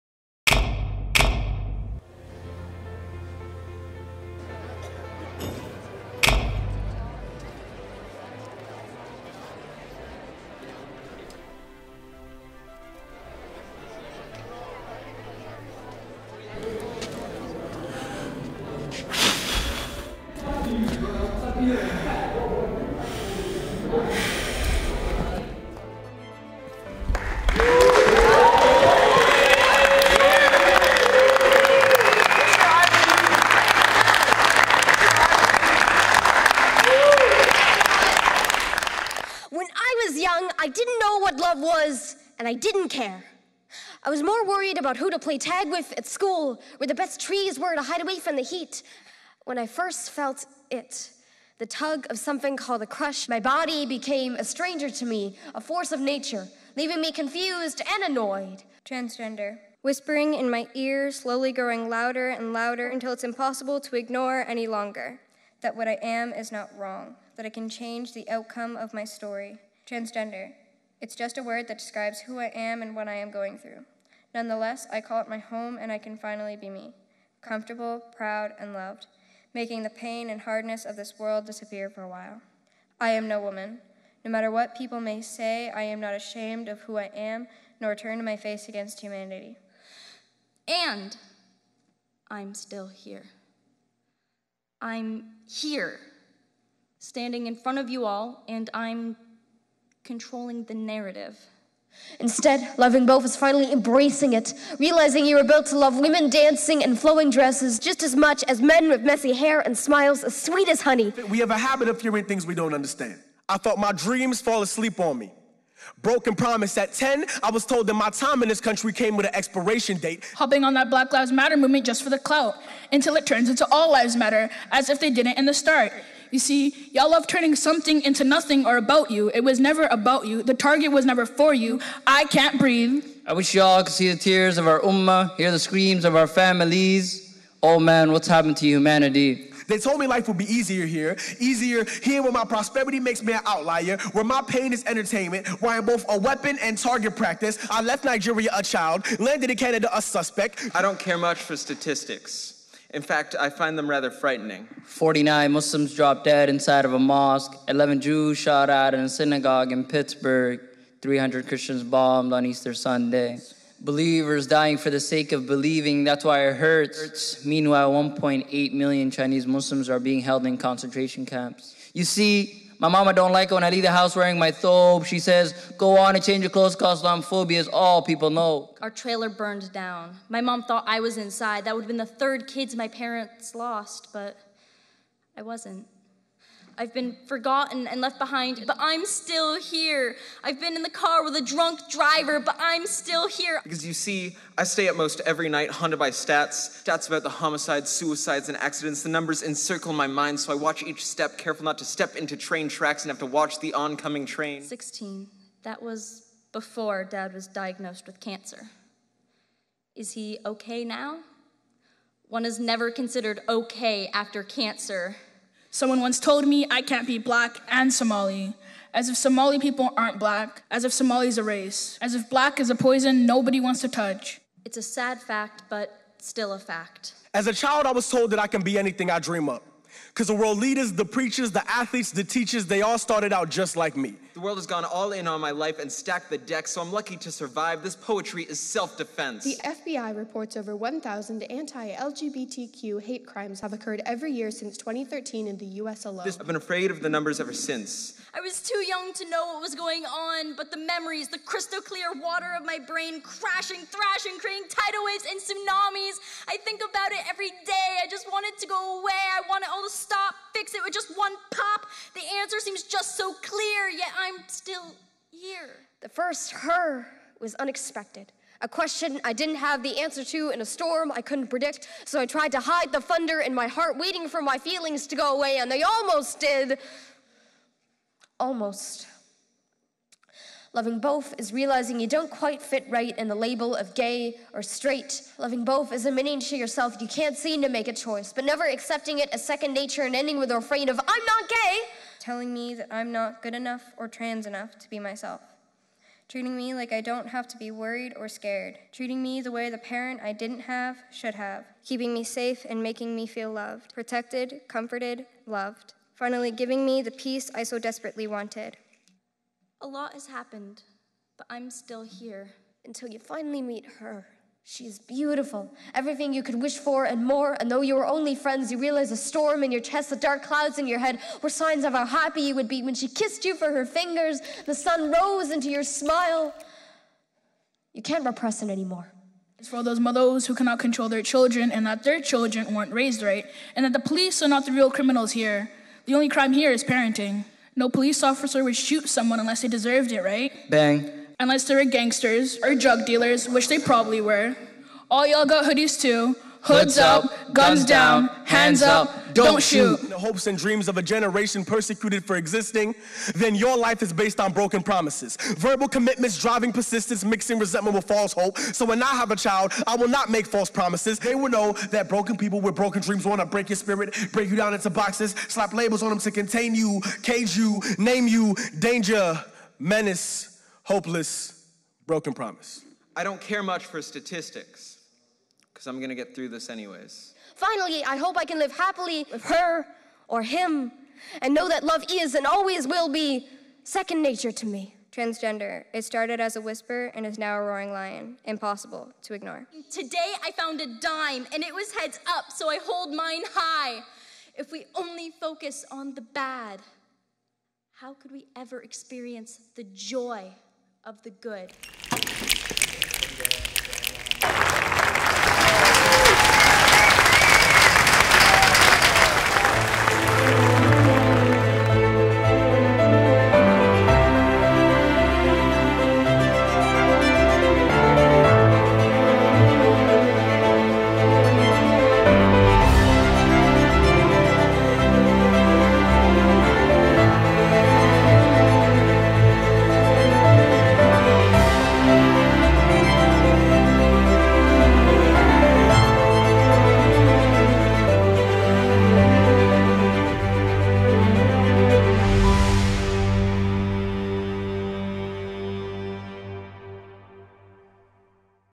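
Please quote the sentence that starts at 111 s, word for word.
We have a habit of hearing things we don't understand.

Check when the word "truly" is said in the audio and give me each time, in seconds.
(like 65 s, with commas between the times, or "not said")
not said.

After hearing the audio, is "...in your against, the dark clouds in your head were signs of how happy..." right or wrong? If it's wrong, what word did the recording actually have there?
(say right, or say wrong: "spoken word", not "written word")
wrong: "chest", not "against".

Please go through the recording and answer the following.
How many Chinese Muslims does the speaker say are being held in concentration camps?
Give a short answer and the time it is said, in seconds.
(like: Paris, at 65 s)
1.8 million, at 167 s.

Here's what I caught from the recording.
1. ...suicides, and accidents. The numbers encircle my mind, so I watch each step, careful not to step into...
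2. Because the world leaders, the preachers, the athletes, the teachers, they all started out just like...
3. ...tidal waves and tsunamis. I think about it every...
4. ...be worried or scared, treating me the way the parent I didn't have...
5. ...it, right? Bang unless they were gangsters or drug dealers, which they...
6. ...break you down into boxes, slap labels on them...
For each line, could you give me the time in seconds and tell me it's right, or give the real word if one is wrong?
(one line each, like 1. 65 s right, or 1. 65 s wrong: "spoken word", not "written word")
1. 197 s right
2. 230 s right
3. 254 s right
4. 297 s right
5. 340 s right
6. 364 s right.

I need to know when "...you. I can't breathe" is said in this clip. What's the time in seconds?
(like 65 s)
131 s.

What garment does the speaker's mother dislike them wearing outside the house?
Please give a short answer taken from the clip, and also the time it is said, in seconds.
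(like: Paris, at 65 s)
thobe, at 174 s.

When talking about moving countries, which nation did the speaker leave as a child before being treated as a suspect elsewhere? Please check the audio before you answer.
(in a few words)
Nigeria.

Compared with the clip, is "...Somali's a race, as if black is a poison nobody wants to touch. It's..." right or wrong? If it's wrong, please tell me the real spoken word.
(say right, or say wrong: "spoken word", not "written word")
right.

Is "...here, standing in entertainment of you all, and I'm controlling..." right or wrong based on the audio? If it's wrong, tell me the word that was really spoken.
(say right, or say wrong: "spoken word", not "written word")
wrong: "front", not "entertainment".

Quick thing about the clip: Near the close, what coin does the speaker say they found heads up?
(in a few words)
dime.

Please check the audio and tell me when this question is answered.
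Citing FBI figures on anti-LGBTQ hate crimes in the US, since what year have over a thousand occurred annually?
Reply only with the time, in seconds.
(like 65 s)
244 s.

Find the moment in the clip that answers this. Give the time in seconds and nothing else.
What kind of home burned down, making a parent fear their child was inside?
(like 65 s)
178 s.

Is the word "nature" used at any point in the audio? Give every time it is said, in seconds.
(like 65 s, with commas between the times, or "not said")
55 s, 289 s, 384 s.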